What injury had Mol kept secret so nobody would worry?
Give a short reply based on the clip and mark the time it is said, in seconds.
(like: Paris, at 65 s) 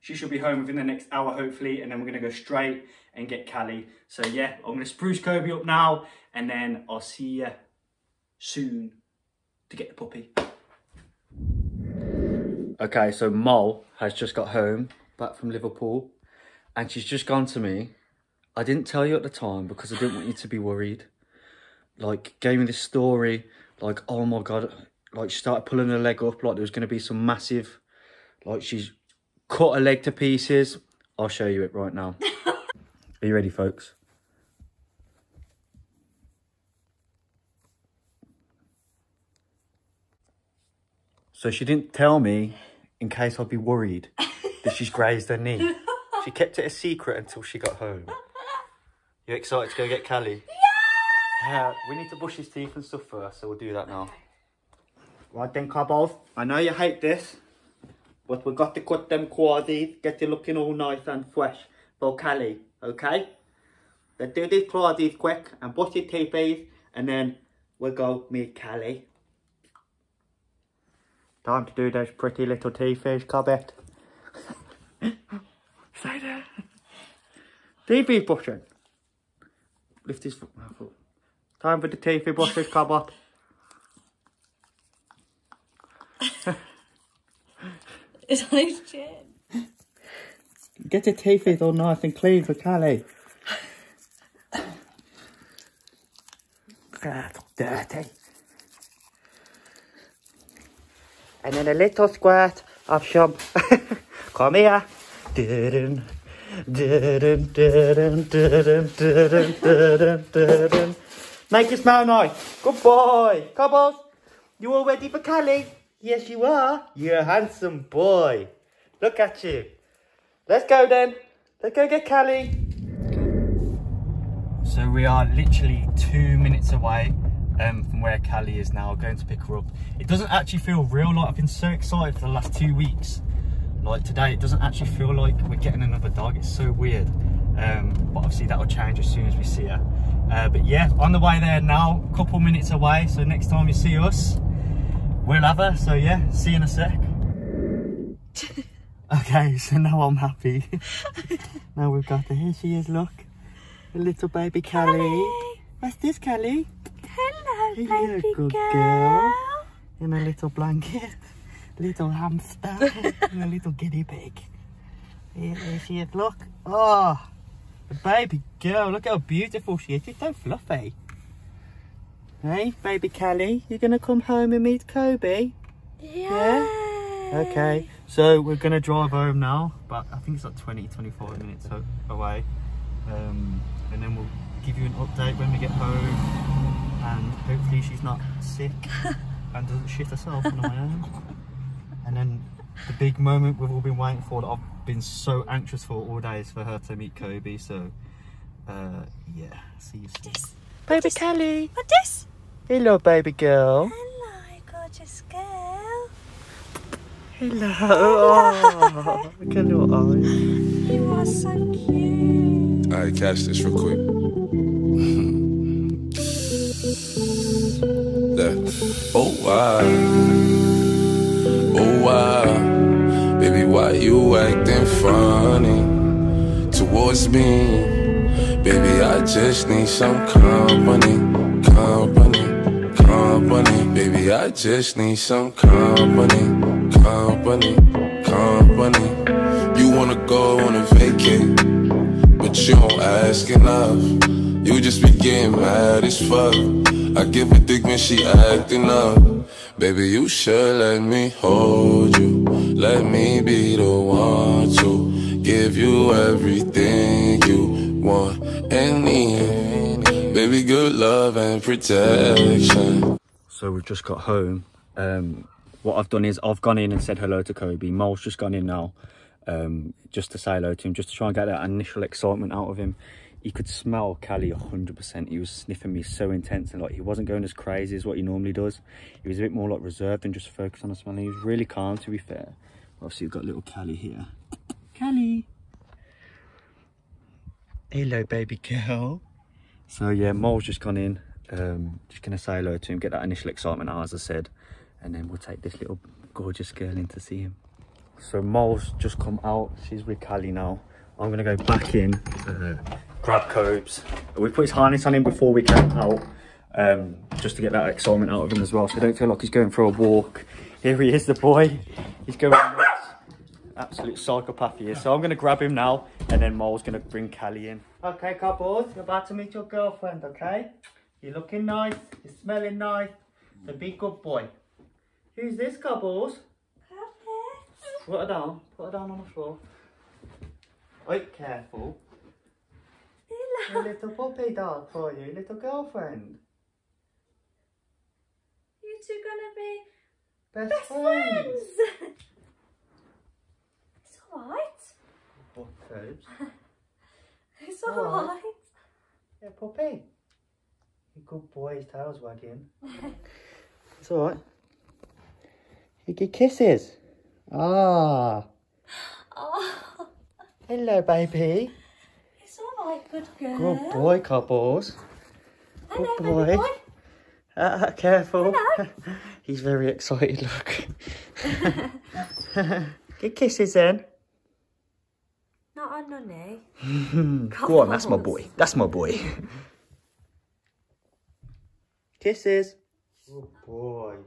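Grazed her knee, at 44 s.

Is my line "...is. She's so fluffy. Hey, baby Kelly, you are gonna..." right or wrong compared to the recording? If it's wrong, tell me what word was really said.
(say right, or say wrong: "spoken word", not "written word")
right.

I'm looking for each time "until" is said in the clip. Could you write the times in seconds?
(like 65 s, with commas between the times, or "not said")
47 s.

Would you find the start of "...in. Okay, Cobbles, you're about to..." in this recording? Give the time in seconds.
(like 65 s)
317 s.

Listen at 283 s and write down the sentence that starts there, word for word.
Obviously we've got little Callie here.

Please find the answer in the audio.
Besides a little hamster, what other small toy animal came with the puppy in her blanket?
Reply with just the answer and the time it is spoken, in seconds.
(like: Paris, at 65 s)
Guinea pig, at 163 s.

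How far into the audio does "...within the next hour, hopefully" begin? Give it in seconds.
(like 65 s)
0 s.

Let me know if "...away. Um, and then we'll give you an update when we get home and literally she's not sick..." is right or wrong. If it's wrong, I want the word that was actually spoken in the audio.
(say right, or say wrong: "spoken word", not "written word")
wrong: "hopefully", not "literally".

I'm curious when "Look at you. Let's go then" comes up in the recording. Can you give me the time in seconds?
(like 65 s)
119 s.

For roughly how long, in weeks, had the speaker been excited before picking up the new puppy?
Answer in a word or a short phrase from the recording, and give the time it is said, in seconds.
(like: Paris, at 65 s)
2 weeks, at 132 s.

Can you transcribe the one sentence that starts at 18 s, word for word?
I didn't tell you at the time because I didn't want you to be worried.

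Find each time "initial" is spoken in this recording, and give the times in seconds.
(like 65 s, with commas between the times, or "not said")
271 s, 293 s.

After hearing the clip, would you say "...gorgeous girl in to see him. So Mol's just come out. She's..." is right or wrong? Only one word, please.
right.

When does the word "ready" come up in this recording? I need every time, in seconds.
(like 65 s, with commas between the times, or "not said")
33 s, 114 s.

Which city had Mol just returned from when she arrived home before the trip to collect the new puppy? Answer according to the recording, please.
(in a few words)
Liverpool.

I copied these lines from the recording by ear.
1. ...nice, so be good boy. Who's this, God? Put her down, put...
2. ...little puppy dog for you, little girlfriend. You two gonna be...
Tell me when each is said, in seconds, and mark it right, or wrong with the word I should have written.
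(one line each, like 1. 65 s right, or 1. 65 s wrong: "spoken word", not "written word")
1. 322 s wrong: "Cobbles", not "God"
2. 333 s right.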